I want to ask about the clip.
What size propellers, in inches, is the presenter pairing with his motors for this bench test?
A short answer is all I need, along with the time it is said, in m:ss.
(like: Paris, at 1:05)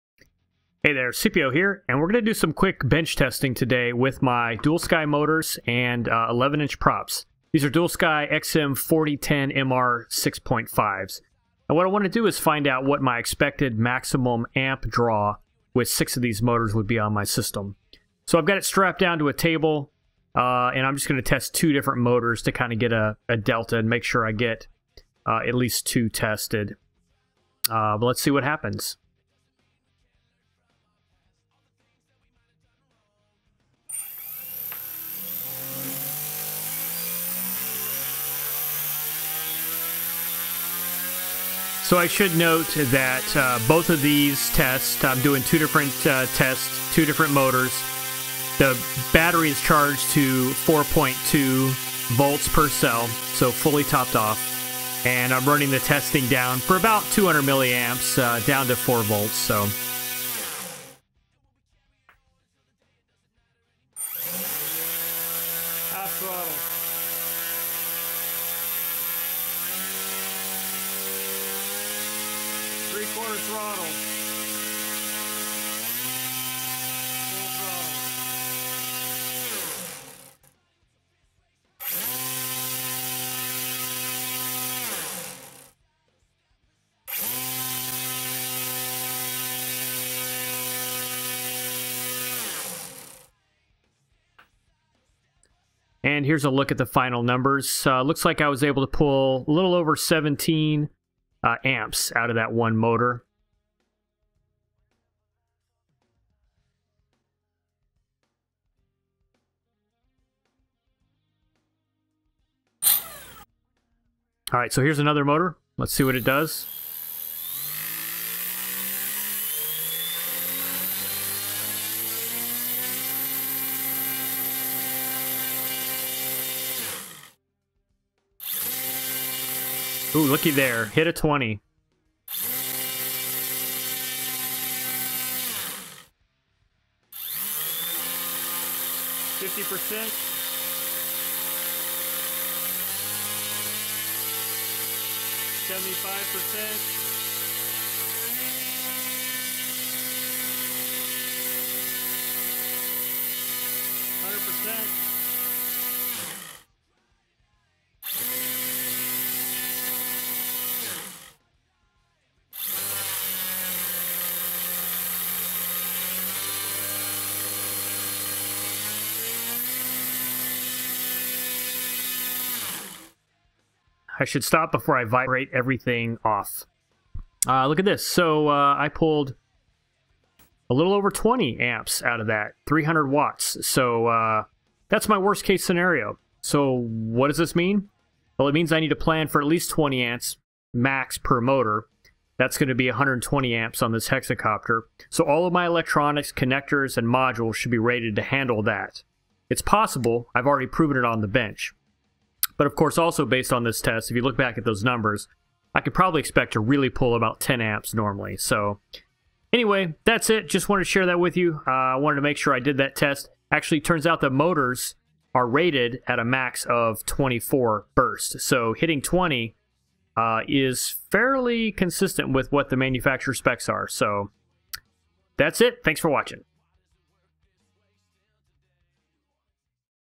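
11-inch, at 0:06.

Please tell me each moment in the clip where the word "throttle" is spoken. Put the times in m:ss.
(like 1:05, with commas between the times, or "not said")
1:06, 1:13.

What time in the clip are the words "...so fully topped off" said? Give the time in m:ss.
0:53.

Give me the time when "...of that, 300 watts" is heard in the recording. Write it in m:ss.
3:02.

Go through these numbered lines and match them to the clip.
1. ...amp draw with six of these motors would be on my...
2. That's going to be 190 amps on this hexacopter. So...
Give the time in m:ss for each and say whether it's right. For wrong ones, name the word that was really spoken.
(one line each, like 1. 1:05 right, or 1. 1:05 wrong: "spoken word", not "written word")
1. 0:14 right
2. 3:12 wrong: "120", not "190".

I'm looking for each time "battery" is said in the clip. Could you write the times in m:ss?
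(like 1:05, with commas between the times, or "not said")
0:49.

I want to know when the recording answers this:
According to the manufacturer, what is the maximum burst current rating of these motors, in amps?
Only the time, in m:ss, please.
3:37.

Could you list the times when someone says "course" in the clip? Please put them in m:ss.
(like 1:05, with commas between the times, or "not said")
3:22.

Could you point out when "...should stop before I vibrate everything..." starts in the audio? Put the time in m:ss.
2:54.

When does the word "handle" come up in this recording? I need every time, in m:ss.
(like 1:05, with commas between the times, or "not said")
3:18.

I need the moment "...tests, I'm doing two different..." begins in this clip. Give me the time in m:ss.
0:44.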